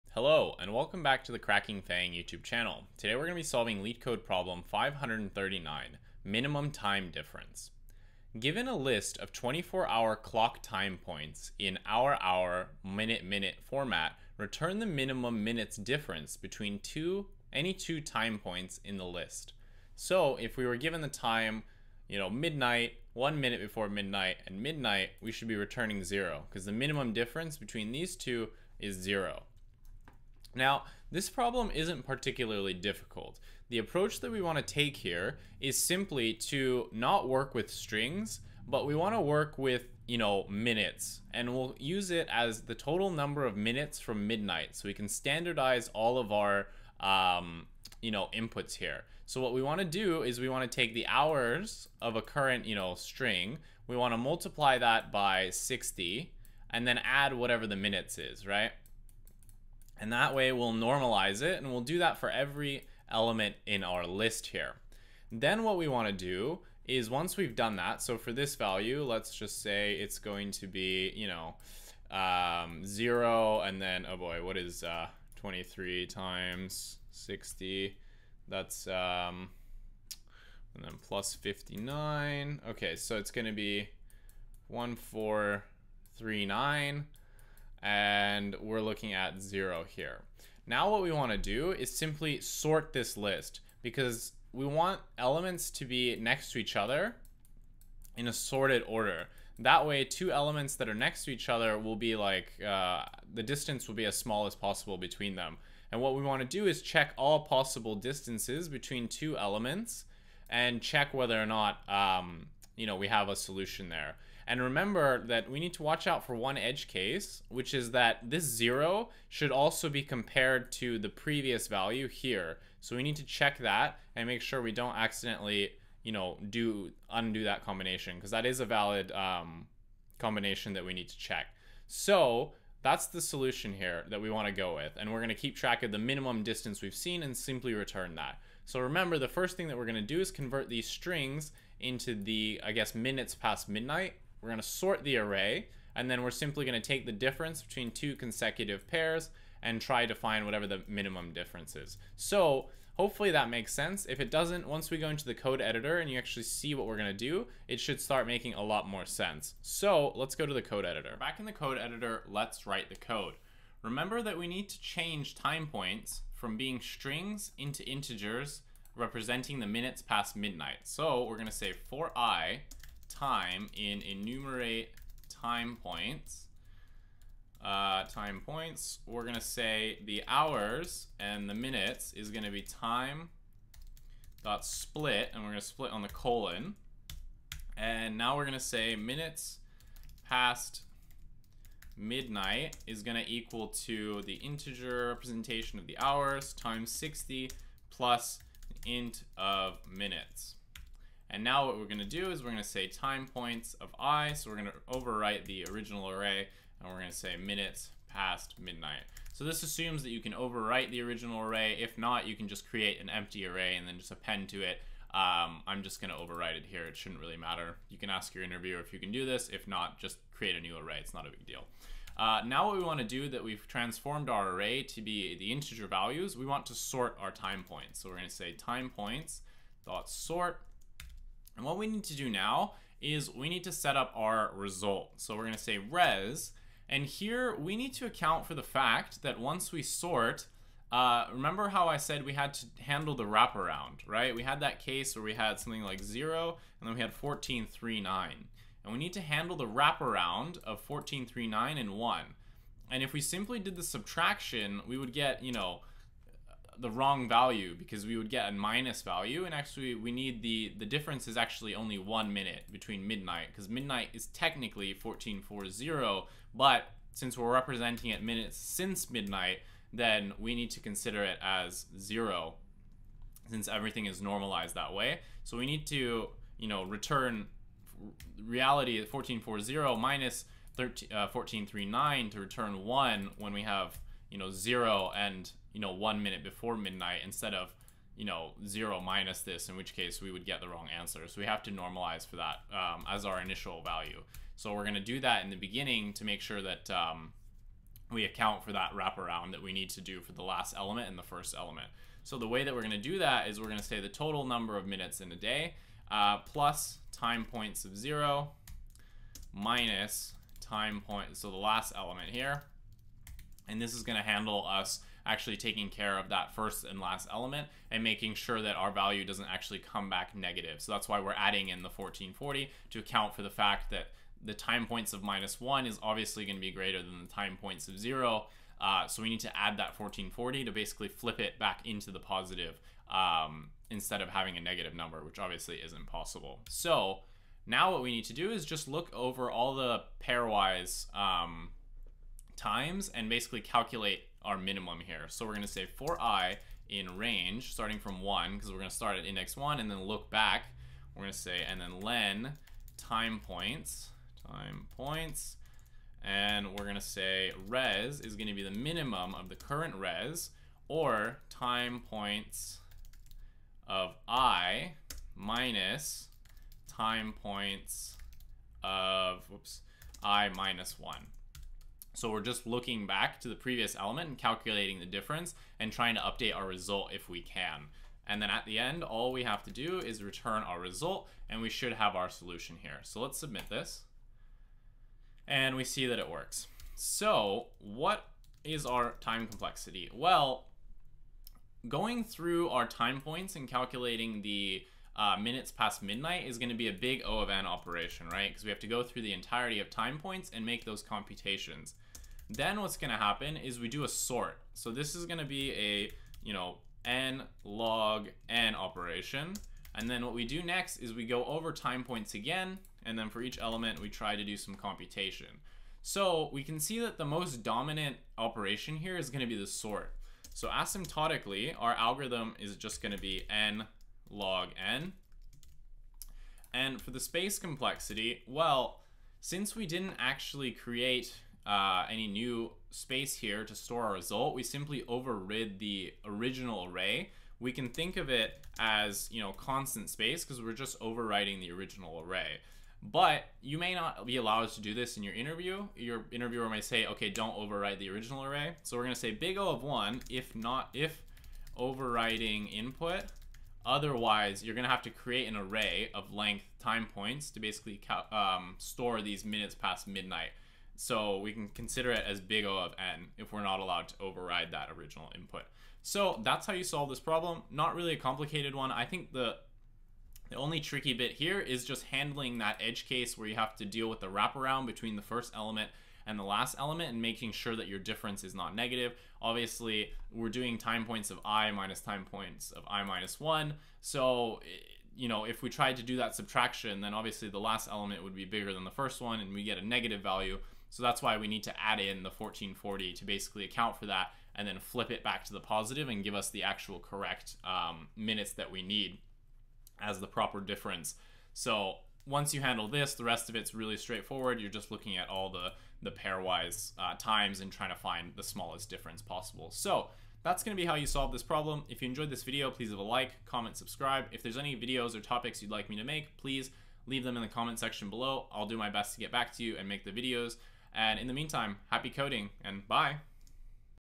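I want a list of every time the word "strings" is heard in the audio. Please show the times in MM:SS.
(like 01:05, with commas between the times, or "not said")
00:37, 00:52, 02:20, 02:46.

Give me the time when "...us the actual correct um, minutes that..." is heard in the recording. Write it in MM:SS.
08:16.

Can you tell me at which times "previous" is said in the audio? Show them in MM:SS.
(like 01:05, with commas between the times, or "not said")
02:01, 06:13.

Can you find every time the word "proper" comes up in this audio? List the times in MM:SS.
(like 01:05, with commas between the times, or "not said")
08:20.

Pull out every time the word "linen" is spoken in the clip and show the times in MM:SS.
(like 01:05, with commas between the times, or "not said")
not said.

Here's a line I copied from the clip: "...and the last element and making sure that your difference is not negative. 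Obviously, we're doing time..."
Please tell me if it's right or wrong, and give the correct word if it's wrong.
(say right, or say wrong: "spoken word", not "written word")
right.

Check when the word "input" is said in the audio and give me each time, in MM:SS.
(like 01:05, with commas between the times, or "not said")
00:48, 07:32, 07:45.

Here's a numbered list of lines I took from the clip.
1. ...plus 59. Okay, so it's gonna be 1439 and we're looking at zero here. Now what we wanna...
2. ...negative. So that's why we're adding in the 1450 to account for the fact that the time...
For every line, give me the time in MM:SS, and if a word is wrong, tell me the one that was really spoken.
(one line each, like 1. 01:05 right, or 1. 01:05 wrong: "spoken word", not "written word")
1. 01:21 right
2. 05:20 wrong: "1440", not "1450".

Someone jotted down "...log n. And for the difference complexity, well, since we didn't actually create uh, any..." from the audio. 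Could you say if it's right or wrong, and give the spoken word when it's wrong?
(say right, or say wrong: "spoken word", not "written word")
wrong: "space", not "difference".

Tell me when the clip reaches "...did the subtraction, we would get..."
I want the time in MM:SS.
04:13.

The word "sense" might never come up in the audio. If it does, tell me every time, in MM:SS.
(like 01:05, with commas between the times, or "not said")
02:33, 02:39.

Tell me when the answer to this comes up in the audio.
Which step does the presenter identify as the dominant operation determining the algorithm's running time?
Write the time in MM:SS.
06:59.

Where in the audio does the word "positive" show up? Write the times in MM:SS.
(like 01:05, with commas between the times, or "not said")
05:32, 08:15.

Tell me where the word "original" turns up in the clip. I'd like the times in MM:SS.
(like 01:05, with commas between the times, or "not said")
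03:25, 03:31, 07:16, 07:21, 07:28, 07:44.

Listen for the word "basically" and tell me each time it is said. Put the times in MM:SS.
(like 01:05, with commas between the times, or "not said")
05:30, 05:43, 07:37, 08:13.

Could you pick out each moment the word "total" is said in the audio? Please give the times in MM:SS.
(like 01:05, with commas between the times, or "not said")
00:42, 05:04.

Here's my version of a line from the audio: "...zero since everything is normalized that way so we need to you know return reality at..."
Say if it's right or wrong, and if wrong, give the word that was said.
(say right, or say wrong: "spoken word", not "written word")
right.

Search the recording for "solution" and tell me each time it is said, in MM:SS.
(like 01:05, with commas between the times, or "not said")
01:53, 02:13, 06:22.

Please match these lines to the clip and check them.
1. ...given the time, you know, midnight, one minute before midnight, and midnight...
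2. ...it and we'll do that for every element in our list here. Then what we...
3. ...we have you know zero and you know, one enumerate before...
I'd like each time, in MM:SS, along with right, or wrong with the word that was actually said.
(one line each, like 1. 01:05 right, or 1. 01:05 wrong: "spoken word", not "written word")
1. 00:20 right
2. 01:01 right
3. 04:43 wrong: "minute", not "enumerate".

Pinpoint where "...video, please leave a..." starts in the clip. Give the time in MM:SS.
08:32.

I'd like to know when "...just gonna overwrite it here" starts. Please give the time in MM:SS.
03:35.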